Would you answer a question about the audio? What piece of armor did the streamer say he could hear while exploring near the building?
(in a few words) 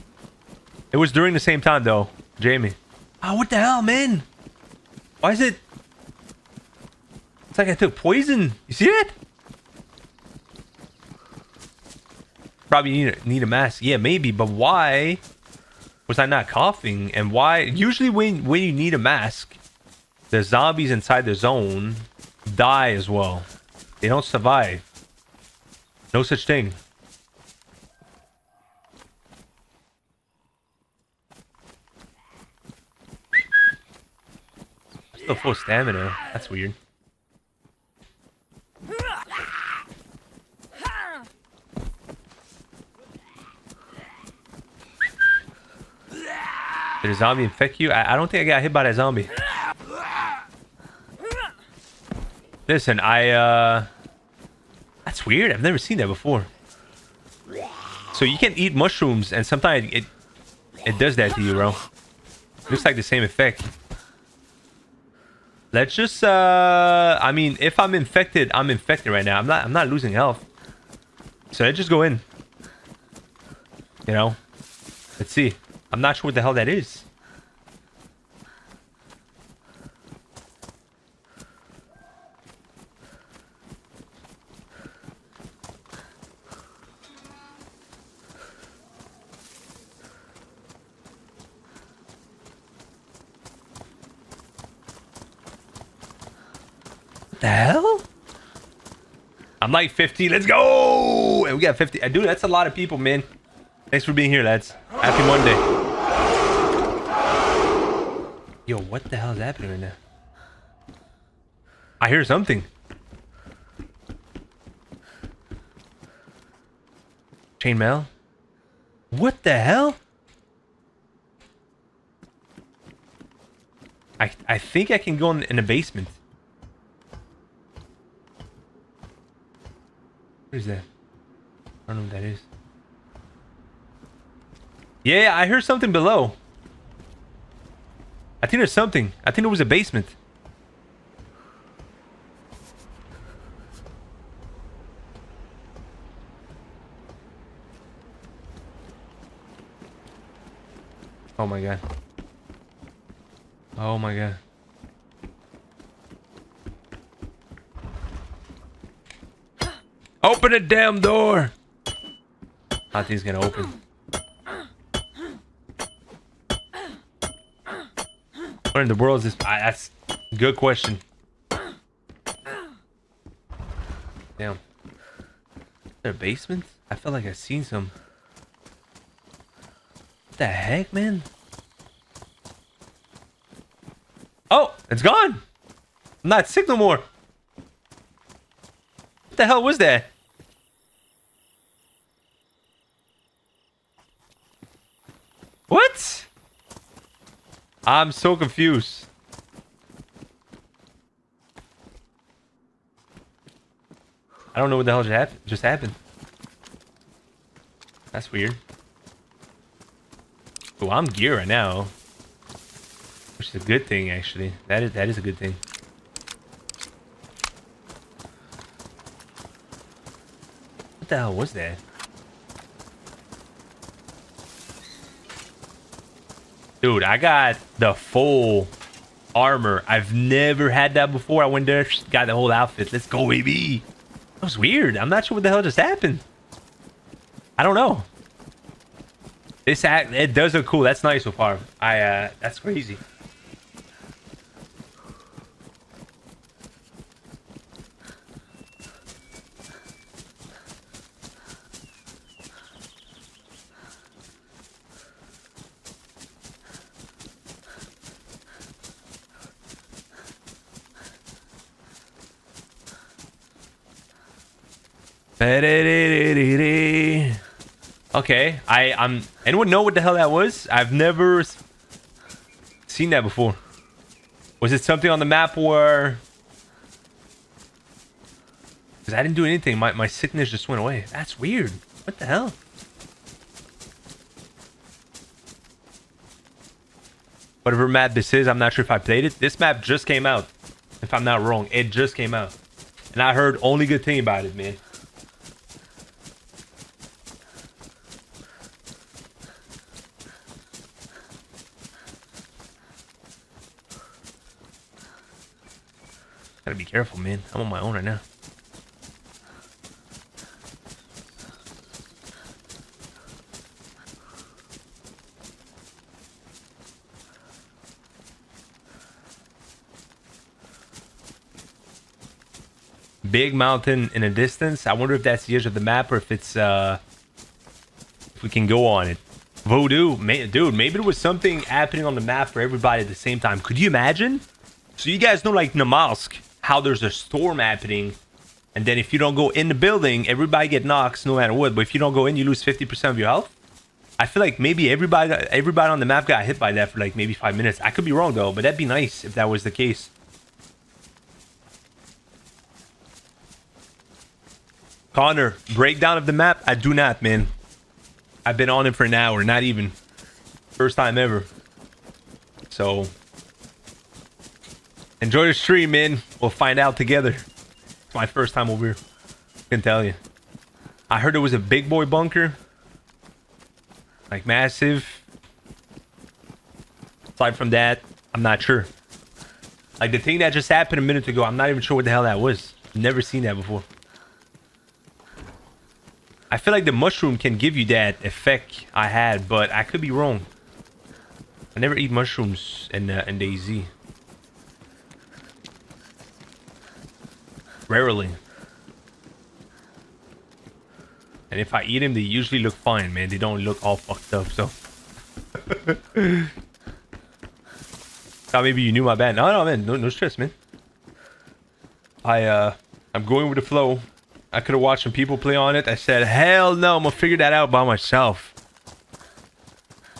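Chainmail.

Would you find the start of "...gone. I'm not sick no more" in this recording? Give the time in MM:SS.
03:05.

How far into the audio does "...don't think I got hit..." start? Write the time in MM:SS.
00:48.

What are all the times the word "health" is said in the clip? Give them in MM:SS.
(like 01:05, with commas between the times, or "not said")
01:10, 05:43.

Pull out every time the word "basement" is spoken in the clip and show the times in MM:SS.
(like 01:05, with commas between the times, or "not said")
02:05, 02:19, 02:56.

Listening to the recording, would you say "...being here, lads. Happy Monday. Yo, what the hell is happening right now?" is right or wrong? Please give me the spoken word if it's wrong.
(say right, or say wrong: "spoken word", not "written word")
right.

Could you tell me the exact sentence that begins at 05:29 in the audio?
Voodoo, man, dude, maybe there was something happening on the map for everybody at the same time.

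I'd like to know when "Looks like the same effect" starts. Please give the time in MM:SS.
01:02.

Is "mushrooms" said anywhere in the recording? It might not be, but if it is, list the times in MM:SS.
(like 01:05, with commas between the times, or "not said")
00:58, 06:26, 06:32.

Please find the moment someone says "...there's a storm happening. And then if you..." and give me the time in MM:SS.
05:36.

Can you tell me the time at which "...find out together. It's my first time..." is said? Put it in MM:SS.
06:06.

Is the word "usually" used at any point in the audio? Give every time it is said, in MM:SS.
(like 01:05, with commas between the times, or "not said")
00:17, 06:42.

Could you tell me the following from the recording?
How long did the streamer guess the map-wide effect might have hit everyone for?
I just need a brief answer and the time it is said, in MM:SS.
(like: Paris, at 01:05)
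five minutes, at 05:47.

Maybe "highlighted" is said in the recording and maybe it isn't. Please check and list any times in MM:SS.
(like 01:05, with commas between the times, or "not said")
not said.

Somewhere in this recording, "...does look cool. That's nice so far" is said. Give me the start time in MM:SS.
04:00.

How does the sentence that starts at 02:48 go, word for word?
Where in the world is this?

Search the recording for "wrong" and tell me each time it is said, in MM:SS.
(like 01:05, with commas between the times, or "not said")
04:51, 05:48, 06:30.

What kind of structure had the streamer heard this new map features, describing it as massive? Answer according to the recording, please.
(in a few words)
big boy bunker.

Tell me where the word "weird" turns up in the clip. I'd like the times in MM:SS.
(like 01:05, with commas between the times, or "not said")
00:36, 00:55, 03:28, 03:54, 04:41.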